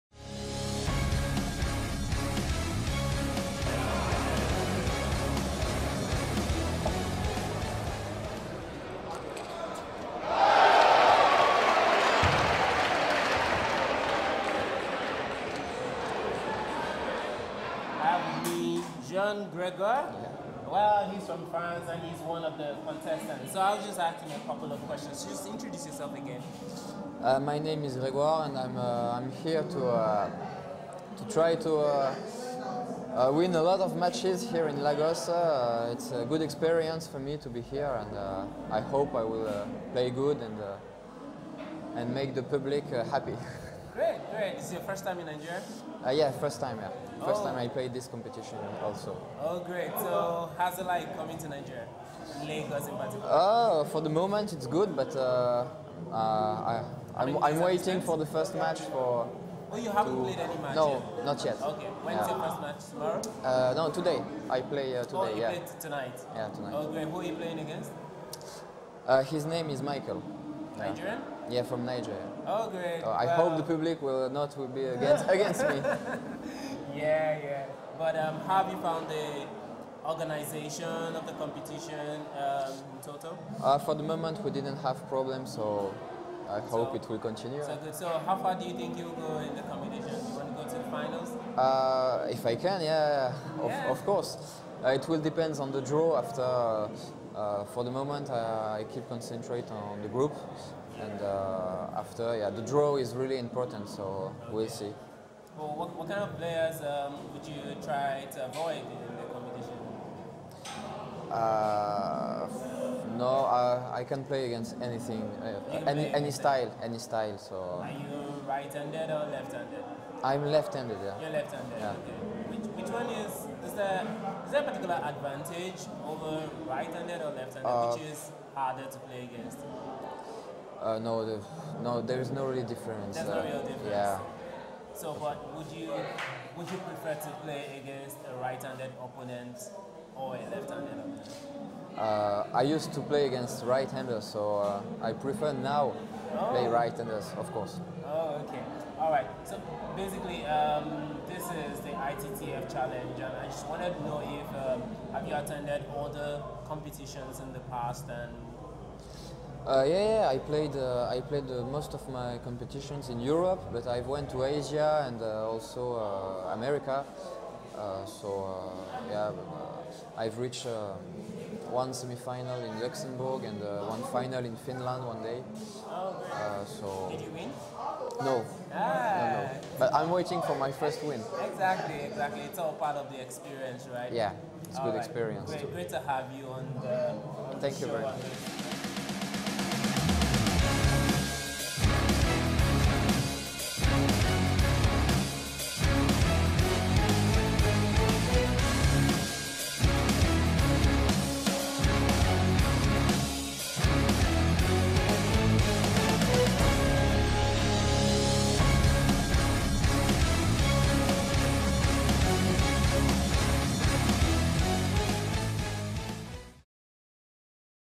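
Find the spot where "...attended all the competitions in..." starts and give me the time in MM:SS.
02:35.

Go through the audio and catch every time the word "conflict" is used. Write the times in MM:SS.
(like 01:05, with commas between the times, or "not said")
not said.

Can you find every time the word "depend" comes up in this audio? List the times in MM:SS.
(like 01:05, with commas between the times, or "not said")
01:35.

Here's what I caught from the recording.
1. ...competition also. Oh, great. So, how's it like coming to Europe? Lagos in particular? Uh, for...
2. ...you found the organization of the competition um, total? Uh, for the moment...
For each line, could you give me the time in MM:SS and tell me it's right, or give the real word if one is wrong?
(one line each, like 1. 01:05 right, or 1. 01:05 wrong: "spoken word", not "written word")
1. 00:48 wrong: "Nigeria", not "Europe"
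2. 01:18 right.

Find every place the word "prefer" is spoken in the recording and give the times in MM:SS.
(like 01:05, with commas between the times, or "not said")
02:16, 02:25.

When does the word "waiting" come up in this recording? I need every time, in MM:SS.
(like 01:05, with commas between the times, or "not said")
00:57, 03:00.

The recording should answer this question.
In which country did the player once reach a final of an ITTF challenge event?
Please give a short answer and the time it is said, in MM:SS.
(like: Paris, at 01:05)
Finland, at 02:54.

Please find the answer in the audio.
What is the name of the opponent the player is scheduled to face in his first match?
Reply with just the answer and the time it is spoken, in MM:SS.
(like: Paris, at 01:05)
Michael, at 01:09.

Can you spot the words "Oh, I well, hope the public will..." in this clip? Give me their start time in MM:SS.
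01:13.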